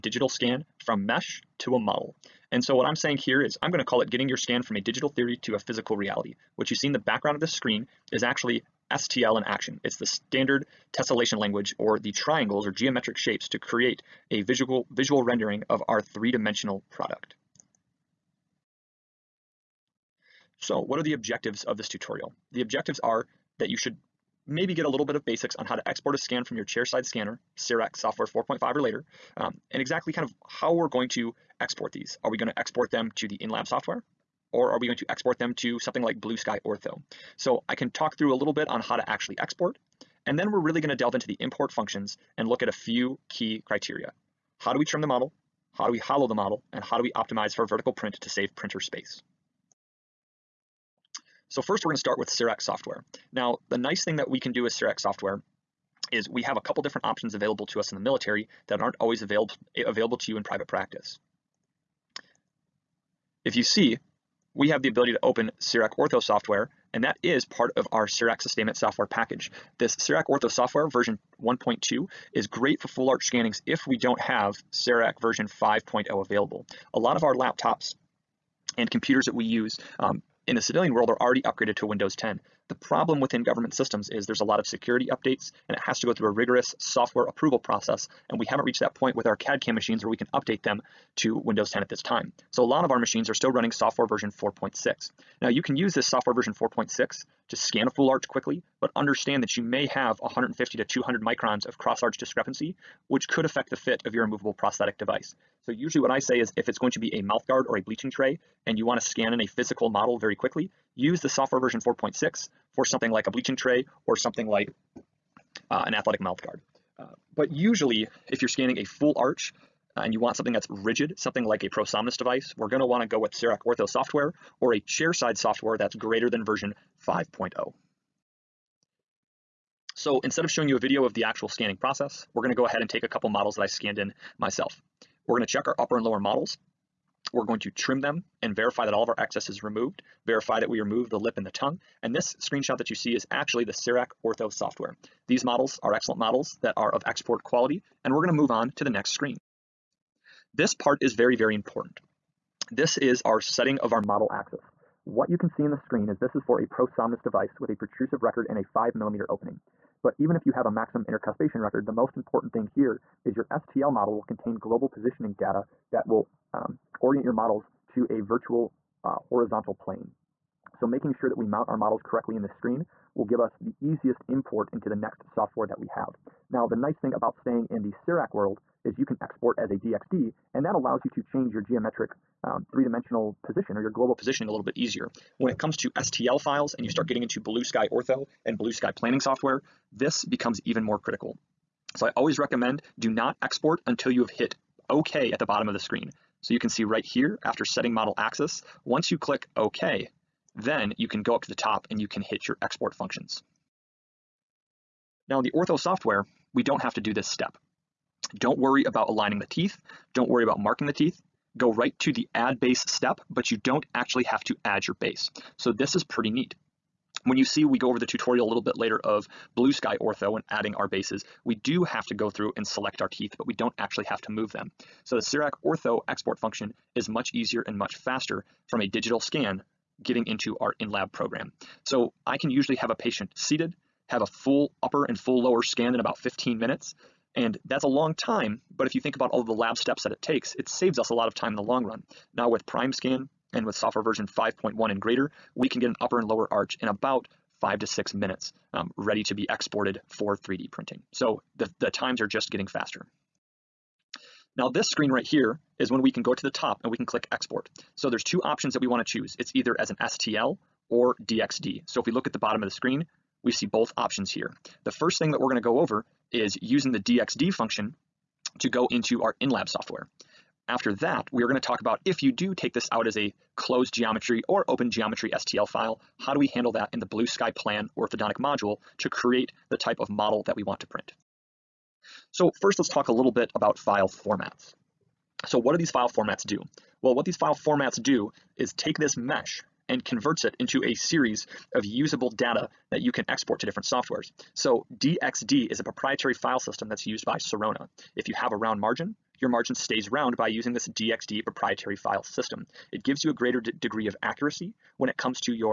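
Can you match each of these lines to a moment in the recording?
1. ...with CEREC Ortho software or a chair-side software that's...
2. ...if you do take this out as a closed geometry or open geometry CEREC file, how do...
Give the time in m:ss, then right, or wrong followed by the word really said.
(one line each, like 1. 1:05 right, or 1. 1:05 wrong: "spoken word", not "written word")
1. 2:03 right
2. 4:32 wrong: "STL", not "CEREC".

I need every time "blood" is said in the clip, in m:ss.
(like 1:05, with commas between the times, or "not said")
not said.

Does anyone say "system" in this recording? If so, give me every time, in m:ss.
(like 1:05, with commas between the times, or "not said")
1:23, 4:56, 5:02.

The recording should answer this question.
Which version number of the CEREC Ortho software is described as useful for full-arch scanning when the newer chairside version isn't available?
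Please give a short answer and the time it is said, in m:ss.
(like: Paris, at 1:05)
1.2, at 1:11.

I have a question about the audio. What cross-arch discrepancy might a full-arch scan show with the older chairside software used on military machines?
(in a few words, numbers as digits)
150 to 200 microns.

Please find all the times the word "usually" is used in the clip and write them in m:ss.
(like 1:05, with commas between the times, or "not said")
1:45, 1:57, 3:52.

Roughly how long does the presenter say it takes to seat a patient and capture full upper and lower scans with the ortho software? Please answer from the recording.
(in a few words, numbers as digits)
15 minutes.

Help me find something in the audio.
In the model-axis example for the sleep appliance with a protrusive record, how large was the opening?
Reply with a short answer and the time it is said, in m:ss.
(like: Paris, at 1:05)
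5 millimeters, at 2:38.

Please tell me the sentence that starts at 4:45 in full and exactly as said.
So what do these file formats do?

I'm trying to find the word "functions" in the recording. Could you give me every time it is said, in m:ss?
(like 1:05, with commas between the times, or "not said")
0:41, 3:22, 3:46, 4:27.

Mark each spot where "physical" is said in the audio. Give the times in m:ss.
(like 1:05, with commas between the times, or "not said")
0:05, 1:49.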